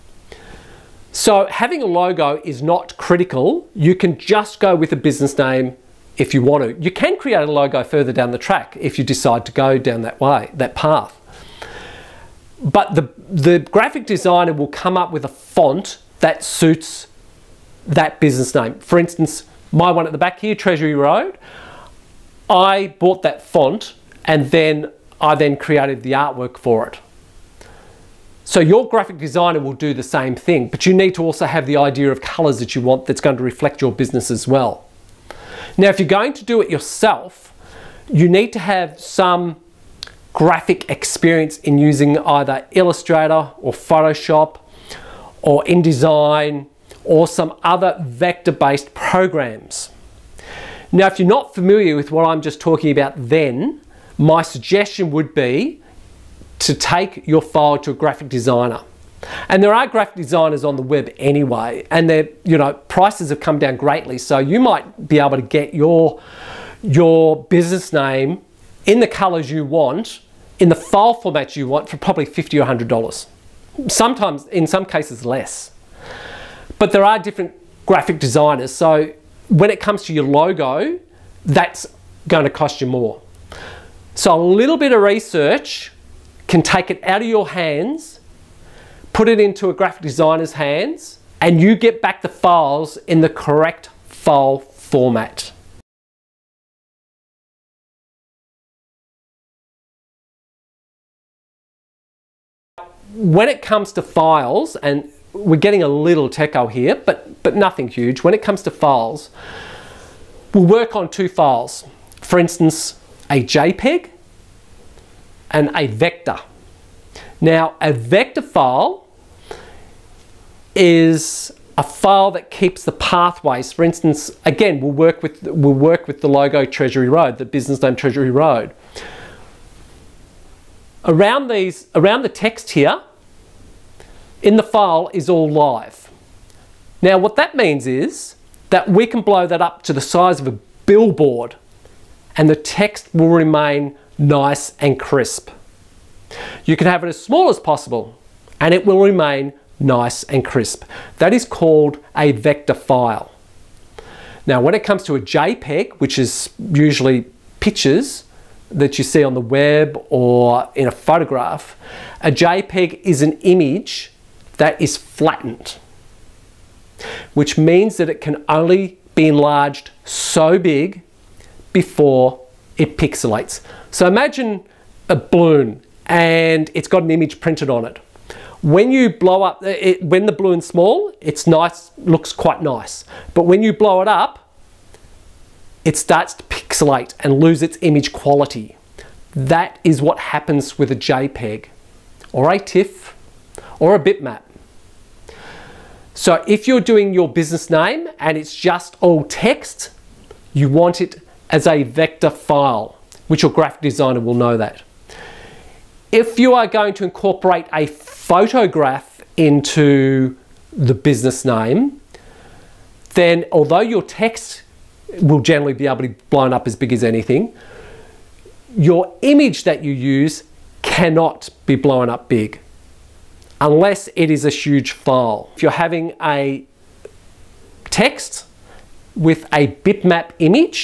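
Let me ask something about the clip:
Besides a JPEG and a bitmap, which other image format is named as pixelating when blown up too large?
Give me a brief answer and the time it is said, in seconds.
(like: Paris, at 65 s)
TIFF, at 192 s.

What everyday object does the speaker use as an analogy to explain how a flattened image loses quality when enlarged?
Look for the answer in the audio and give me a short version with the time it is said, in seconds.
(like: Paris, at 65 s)
A balloon, at 175 s.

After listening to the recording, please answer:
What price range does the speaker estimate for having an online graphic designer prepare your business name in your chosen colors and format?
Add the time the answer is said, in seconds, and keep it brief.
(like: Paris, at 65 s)
$50 to $100, at 72 s.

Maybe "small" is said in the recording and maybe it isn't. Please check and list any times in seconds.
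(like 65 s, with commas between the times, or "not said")
147 s, 180 s.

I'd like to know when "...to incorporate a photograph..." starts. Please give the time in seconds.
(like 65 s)
206 s.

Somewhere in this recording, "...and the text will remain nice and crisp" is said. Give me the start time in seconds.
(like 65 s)
142 s.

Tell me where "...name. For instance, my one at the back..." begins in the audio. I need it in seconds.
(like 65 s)
18 s.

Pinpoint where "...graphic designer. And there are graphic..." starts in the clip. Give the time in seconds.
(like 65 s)
57 s.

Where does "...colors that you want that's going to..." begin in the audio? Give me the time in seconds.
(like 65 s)
32 s.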